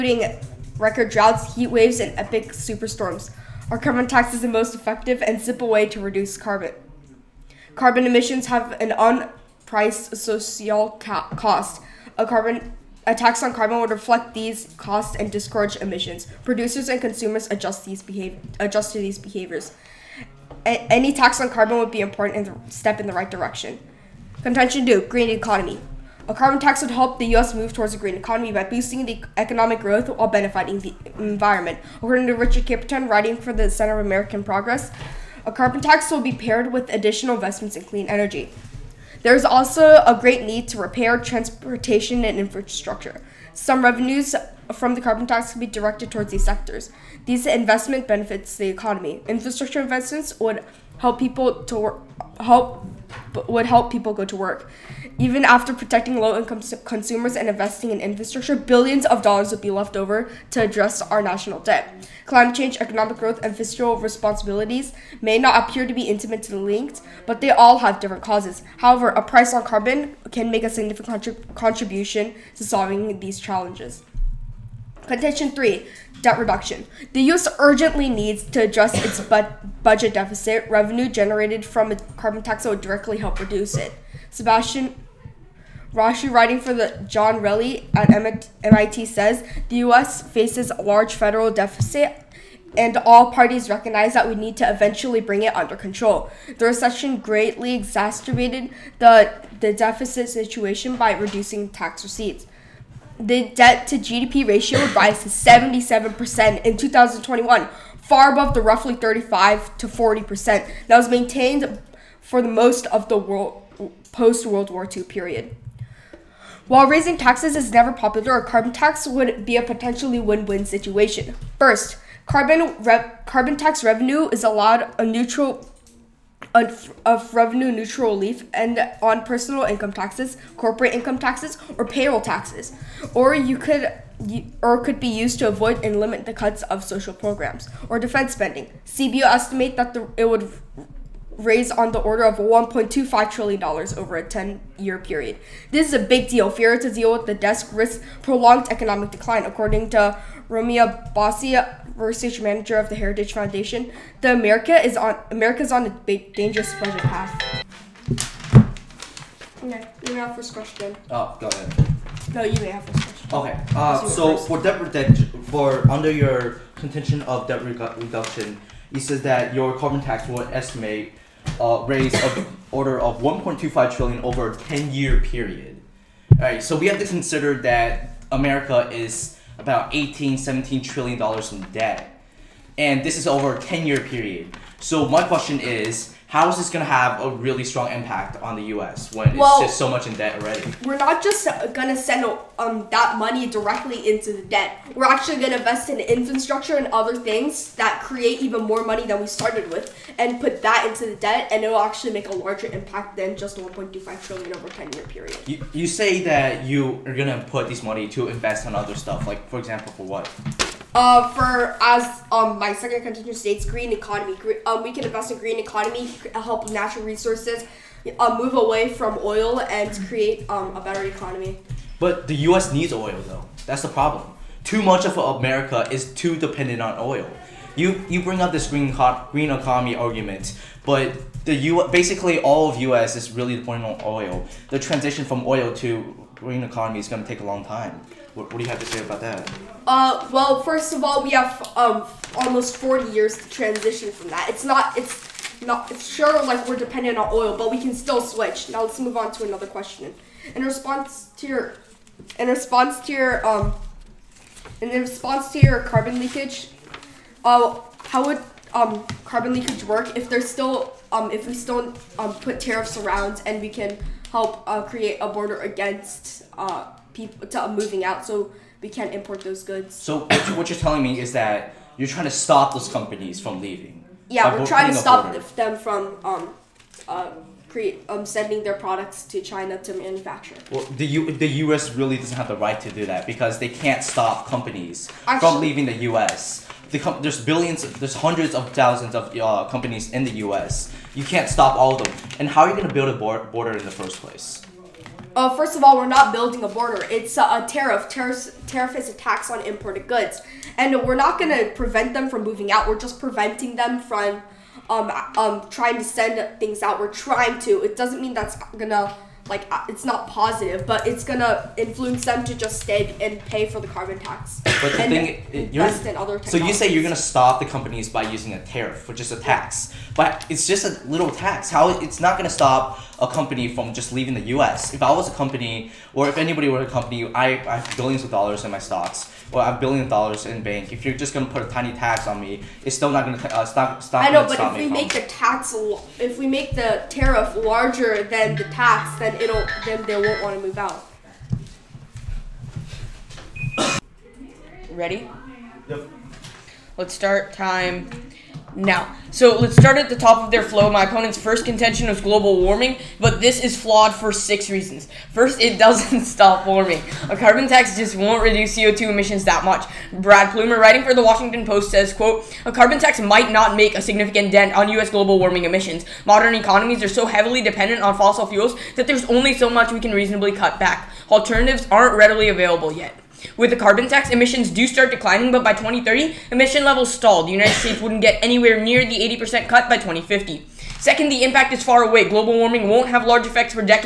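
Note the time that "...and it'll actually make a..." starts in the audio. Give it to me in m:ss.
3:21.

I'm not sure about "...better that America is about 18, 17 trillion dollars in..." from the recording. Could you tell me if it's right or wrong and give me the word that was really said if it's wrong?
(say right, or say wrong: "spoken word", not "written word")
wrong: "consider", not "better".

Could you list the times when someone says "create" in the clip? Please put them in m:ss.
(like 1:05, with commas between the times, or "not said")
3:18, 3:40, 4:24.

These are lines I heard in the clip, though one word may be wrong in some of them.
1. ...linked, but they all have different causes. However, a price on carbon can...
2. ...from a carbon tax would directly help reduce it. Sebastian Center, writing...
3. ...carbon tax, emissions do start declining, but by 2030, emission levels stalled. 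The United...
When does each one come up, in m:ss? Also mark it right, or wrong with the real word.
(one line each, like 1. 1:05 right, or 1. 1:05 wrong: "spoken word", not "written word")
1. 1:06 right
2. 1:21 wrong: "Rausch", not "Center"
3. 6:13 right.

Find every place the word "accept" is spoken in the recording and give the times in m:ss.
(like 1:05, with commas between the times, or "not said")
not said.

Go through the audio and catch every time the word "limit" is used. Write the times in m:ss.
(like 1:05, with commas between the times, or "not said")
2:15.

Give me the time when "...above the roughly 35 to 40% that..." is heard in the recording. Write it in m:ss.
1:48.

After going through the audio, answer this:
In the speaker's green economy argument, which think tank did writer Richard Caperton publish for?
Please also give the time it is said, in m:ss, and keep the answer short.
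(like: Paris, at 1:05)
Center of American Progress, at 0:33.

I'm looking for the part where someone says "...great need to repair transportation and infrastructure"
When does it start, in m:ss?
0:40.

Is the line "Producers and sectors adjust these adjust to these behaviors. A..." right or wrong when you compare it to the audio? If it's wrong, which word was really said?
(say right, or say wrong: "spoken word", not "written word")
wrong: "consumers", not "sectors".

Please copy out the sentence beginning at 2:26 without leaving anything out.
Failure to deal with the desk risks prolonged economic decline.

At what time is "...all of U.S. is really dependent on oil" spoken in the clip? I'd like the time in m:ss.
3:52.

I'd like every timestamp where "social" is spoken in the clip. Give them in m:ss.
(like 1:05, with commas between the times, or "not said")
0:10, 2:16.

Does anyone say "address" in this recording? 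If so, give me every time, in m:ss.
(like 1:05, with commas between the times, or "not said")
1:00, 1:18.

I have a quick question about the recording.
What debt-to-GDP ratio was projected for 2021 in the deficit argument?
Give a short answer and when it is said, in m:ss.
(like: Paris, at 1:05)
77%, at 1:45.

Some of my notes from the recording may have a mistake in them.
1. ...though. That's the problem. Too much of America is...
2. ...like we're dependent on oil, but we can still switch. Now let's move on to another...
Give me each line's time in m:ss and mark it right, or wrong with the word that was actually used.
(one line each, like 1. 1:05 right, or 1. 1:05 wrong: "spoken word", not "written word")
1. 3:43 right
2. 4:06 right.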